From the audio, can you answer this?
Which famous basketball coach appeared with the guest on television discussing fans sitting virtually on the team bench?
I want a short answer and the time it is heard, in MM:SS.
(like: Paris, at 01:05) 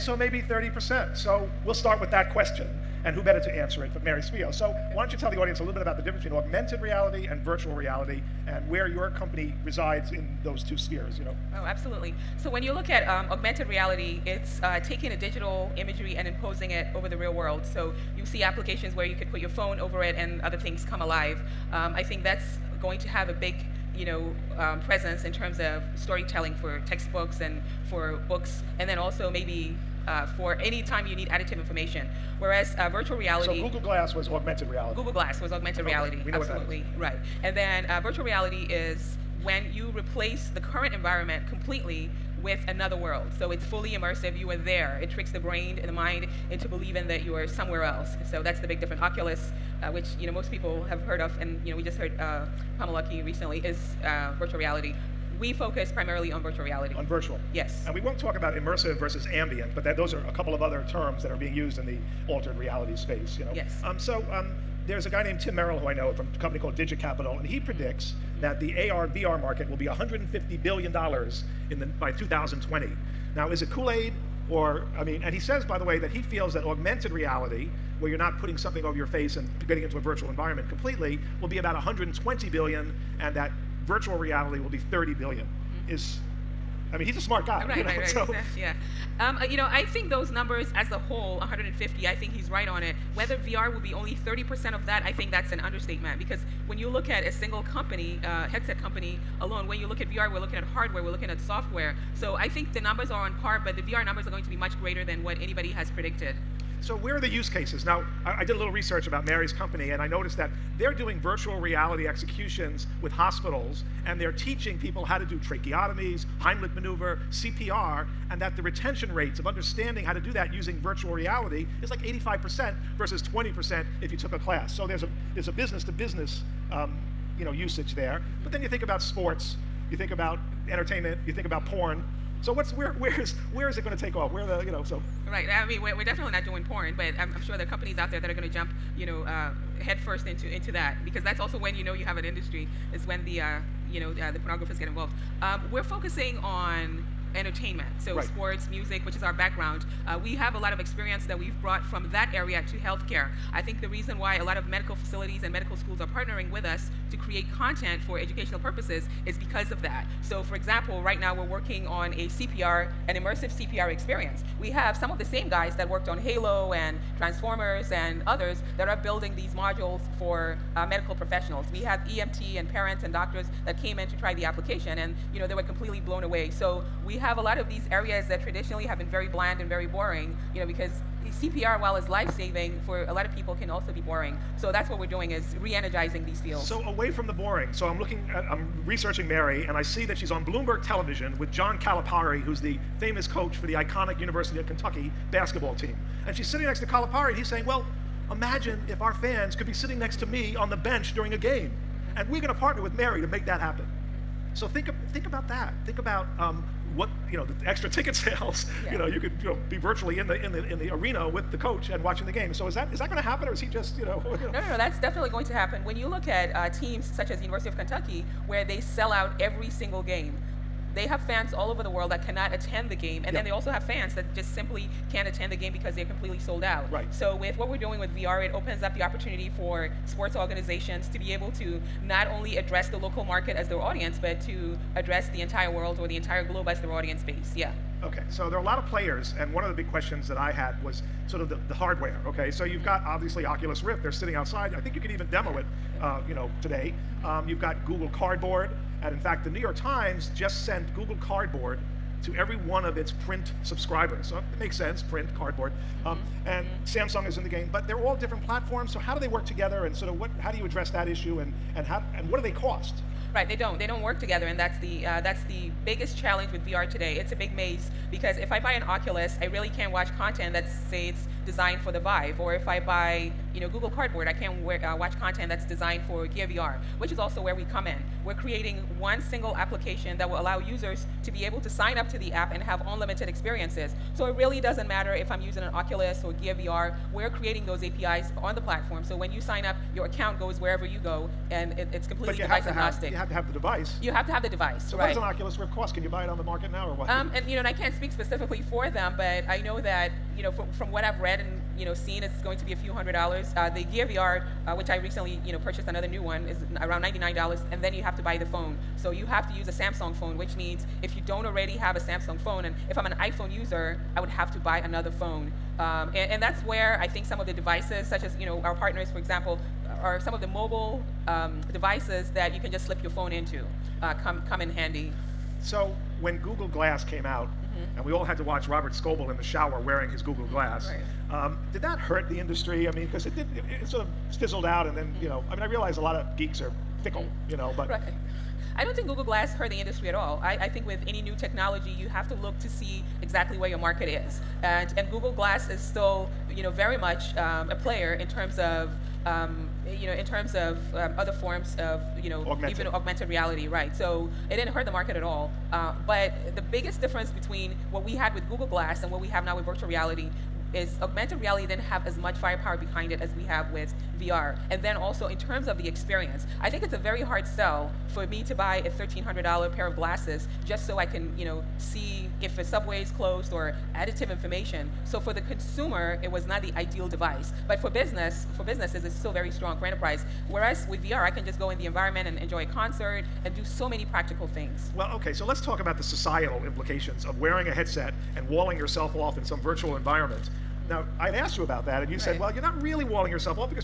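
John Calipari, at 03:11.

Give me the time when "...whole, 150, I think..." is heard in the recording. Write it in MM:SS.
01:30.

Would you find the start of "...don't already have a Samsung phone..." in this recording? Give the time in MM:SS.
05:11.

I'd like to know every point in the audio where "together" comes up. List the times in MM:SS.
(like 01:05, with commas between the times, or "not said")
04:19, 04:24.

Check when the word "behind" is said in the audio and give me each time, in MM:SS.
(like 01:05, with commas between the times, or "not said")
06:02.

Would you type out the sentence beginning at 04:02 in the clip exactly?
So you've got obviously Oculus Rift, they're sitting outside.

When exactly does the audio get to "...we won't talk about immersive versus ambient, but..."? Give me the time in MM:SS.
00:57.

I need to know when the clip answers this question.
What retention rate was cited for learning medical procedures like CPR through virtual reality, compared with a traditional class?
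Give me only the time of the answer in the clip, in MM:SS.
02:02.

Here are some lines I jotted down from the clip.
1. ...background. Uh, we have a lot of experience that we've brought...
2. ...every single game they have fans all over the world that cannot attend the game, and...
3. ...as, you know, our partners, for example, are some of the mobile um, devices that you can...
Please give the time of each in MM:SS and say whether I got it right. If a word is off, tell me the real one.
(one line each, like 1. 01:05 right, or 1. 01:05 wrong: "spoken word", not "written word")
1. 02:29 right
2. 03:39 right
3. 05:18 right.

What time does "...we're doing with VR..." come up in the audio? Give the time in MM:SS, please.
03:47.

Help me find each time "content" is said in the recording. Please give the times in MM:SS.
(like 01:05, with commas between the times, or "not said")
02:37, 04:30, 04:35.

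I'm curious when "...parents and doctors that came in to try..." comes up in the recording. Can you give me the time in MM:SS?
02:52.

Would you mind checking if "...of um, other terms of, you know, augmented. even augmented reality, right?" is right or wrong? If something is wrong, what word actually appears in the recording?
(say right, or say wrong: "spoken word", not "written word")
wrong: "forms", not "terms".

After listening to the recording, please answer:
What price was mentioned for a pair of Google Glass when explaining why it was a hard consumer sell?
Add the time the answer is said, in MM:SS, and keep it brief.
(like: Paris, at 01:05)
$1,300, at 06:08.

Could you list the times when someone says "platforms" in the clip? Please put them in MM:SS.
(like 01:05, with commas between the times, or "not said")
04:18, 04:48.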